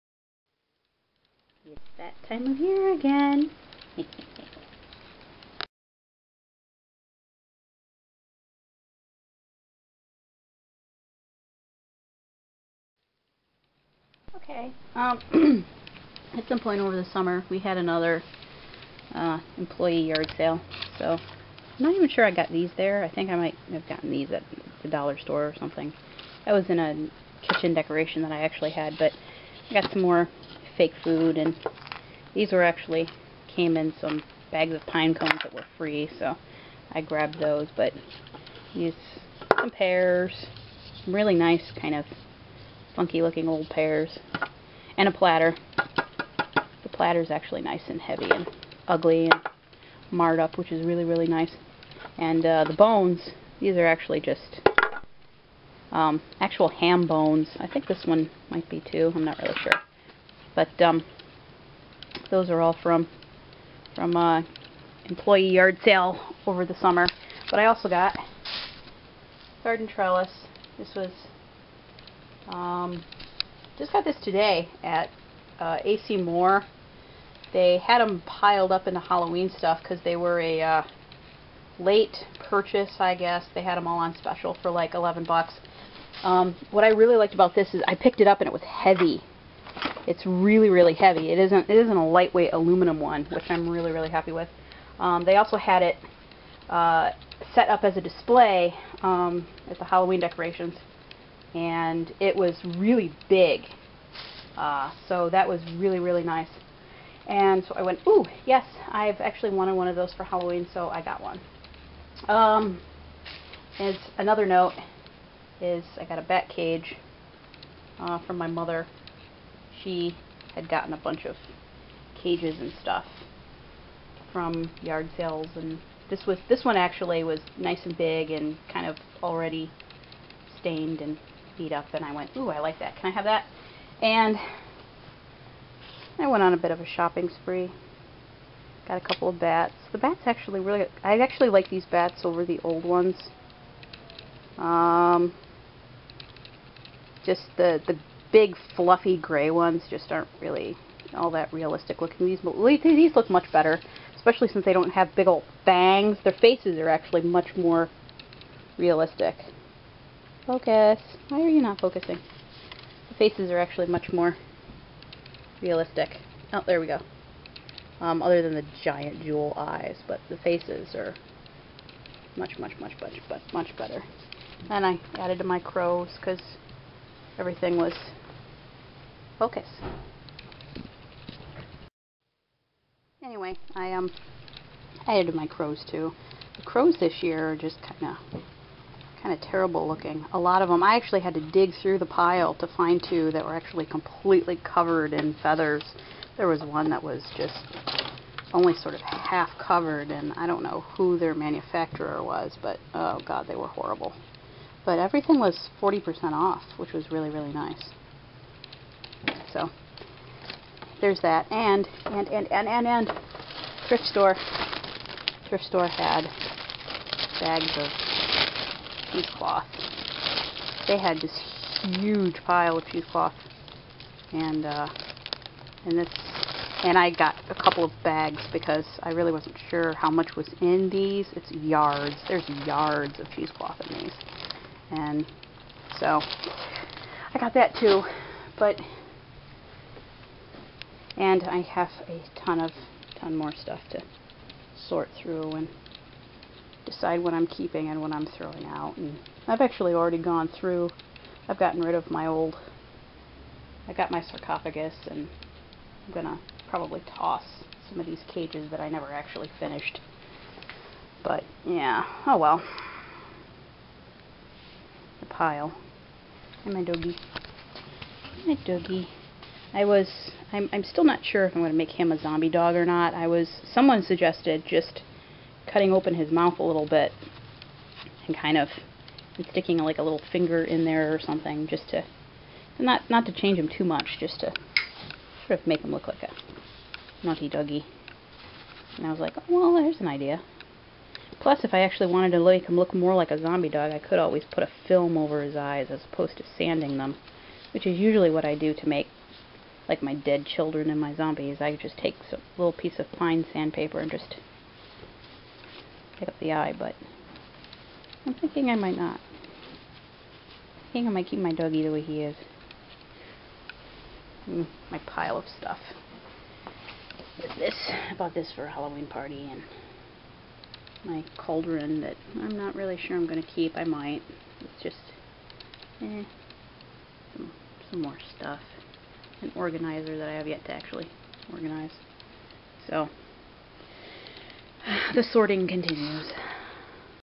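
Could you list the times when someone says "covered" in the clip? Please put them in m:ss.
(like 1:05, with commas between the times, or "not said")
3:14, 3:19.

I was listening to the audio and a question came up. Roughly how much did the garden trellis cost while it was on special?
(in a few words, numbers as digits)
$11.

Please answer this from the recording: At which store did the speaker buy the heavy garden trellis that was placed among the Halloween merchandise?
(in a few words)
AC Moore.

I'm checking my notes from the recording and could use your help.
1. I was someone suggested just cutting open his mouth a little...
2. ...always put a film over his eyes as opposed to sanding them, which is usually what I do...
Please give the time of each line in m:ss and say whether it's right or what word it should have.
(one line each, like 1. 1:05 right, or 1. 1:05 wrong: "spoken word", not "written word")
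1. 4:33 right
2. 4:54 right.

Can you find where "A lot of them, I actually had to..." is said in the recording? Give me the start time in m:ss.
3:10.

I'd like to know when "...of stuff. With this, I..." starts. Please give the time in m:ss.
5:15.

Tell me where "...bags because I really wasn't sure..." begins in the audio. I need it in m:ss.
3:48.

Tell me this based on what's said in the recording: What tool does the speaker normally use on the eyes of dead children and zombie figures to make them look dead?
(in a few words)
Fine sandpaper.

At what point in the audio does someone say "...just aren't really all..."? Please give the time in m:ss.
2:29.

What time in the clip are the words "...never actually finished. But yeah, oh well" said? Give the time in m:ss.
4:18.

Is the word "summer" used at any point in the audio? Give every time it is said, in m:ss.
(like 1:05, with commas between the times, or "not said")
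0:17, 1:06.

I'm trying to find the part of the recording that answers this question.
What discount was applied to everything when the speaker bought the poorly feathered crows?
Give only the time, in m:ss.
3:25.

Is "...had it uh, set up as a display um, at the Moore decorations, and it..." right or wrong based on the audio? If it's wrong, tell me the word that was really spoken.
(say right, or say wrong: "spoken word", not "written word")
wrong: "Halloween", not "Moore".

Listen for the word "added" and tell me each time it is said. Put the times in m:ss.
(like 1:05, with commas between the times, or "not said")
2:55, 3:05.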